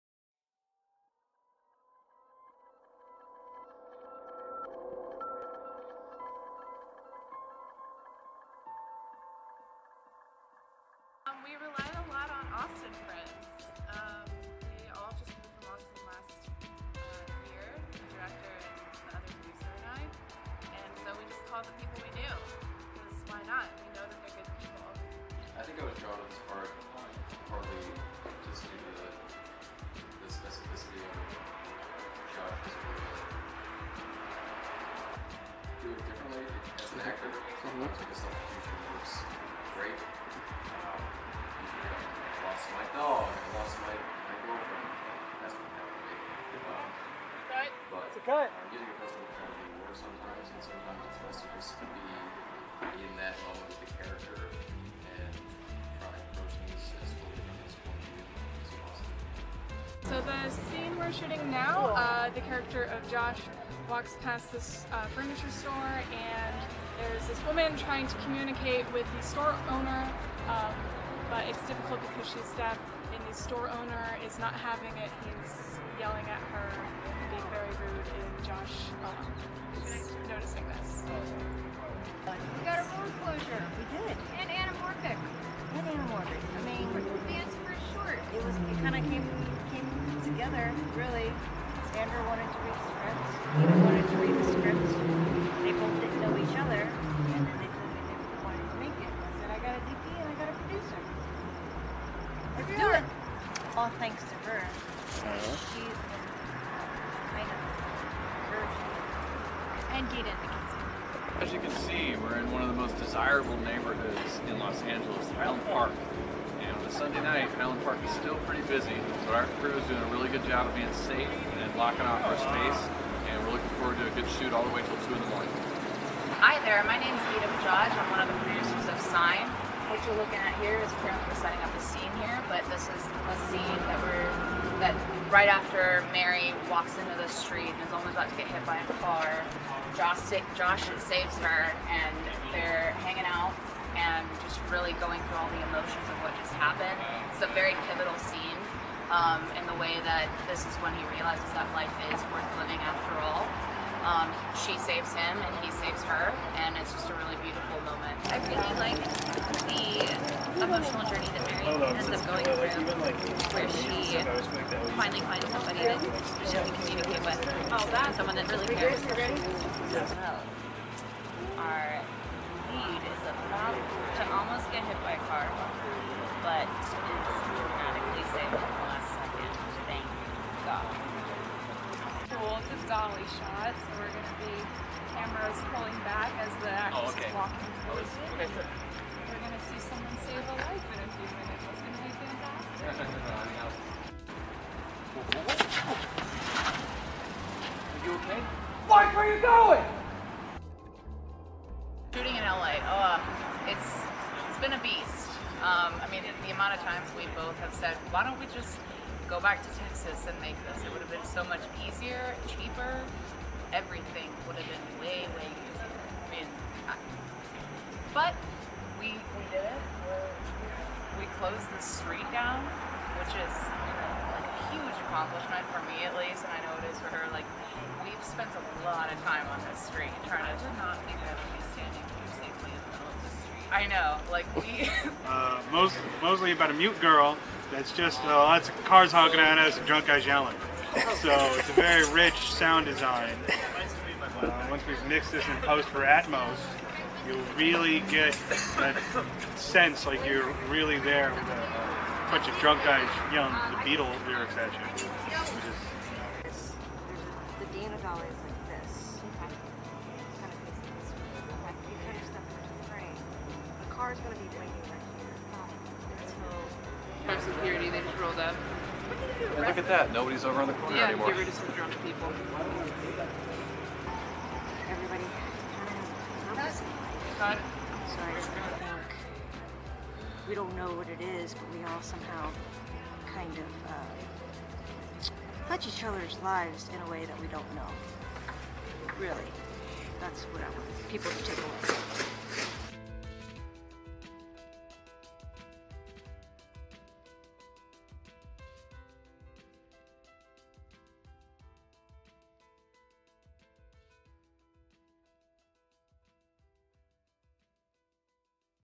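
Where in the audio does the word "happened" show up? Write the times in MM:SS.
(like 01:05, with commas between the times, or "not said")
02:26.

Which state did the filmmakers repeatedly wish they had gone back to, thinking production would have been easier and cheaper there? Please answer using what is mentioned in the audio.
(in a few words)
Texas.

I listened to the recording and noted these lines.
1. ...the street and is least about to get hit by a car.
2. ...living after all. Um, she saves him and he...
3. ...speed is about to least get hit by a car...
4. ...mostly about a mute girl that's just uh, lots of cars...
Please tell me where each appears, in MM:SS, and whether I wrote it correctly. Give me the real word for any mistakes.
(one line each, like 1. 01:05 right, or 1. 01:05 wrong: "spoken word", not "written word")
1. 02:17 wrong: "almost", not "least"
2. 02:32 right
3. 02:52 wrong: "almost", not "least"
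4. 03:56 right.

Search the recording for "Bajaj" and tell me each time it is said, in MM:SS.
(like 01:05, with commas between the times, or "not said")
02:07.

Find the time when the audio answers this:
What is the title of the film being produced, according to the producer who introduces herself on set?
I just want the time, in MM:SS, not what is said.
02:09.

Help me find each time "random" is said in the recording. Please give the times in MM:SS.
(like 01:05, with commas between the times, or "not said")
not said.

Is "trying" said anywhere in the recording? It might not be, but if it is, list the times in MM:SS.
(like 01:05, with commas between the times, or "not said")
01:07, 03:50.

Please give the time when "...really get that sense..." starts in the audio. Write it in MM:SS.
04:07.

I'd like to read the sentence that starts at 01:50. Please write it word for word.
And Jaden As you can see, we're in one of the most desirable neighborhoods in Los Angeles, Highland Park.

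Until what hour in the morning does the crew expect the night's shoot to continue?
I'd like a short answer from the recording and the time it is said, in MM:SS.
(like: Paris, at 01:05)
2, at 02:05.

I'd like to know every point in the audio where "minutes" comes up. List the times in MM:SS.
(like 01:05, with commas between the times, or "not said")
03:11.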